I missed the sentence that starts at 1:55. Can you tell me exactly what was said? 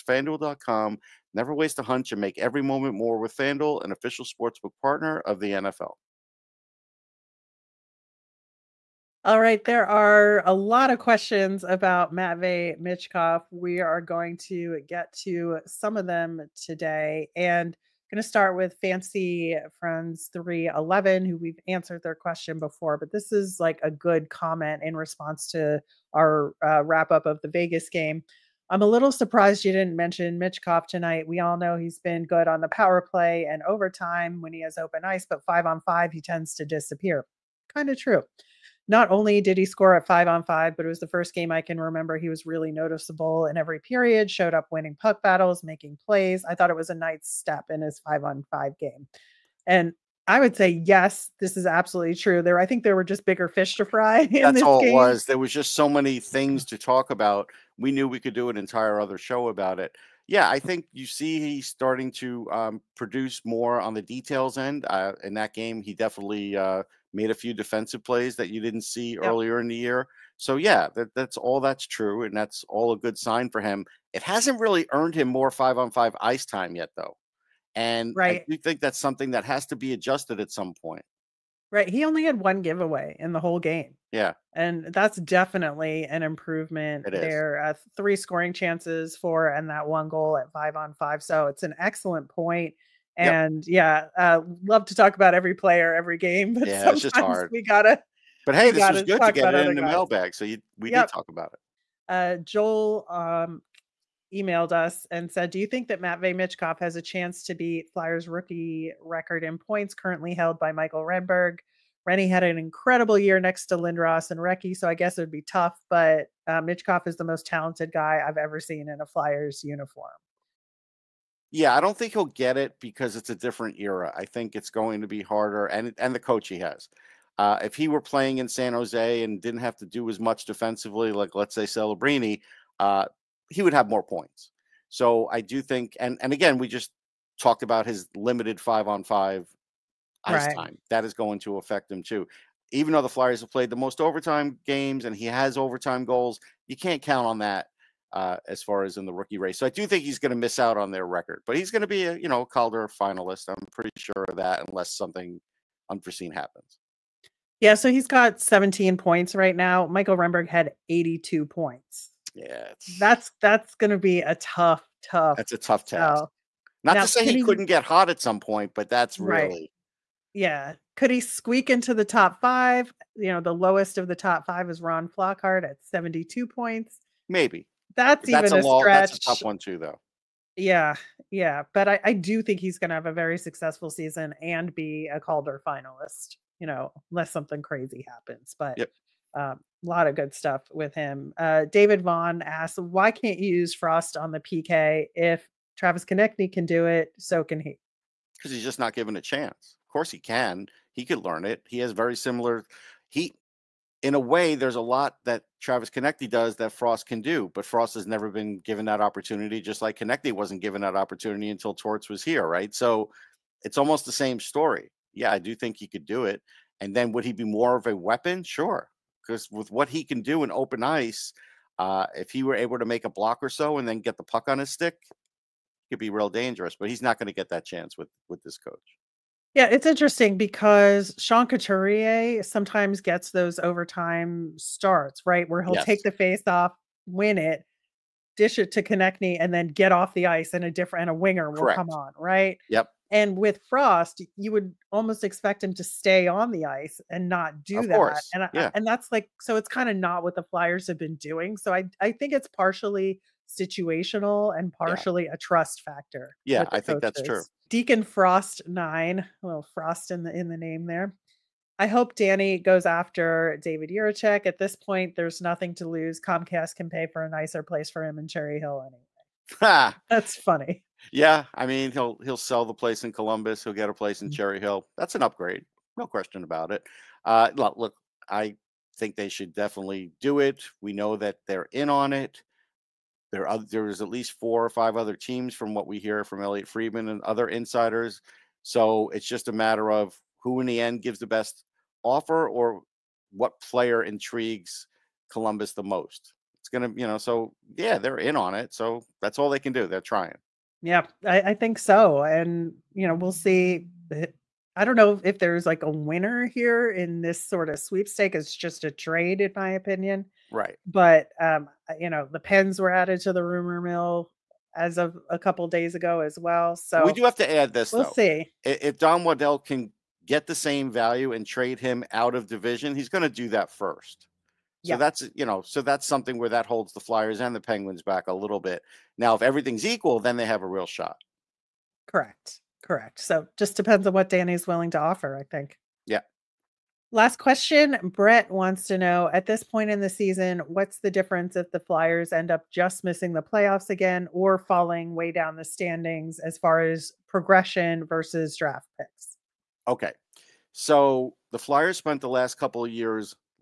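But uh, is the most talented guy I've ever seen in a Flyers uniform.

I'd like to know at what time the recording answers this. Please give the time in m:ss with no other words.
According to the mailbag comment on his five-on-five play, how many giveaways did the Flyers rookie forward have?
1:22.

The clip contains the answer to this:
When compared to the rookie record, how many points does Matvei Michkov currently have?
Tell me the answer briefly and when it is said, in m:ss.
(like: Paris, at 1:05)
17, at 2:38.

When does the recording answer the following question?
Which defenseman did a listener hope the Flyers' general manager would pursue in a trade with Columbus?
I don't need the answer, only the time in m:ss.
4:23.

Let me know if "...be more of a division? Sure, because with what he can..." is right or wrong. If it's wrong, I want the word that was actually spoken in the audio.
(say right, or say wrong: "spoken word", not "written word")
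wrong: "weapon", not "division".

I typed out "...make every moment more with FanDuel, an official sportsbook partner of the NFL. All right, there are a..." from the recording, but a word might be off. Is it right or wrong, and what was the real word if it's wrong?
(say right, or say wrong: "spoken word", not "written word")
right.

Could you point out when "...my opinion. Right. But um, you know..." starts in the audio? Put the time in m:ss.
5:09.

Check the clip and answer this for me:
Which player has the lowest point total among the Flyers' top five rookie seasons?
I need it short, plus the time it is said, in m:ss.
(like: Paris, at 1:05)
Ron Flockhart, at 2:54.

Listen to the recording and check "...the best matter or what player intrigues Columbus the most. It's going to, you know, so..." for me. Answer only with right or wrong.
wrong.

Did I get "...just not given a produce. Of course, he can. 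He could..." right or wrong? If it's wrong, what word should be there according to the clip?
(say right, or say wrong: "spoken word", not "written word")
wrong: "chance", not "produce".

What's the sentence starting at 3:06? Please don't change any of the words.
You know, unless something crazy happens, but yep.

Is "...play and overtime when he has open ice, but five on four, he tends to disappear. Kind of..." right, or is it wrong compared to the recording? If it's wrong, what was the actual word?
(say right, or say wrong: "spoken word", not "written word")
wrong: "five", not "four".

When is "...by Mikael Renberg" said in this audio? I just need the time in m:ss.
1:50.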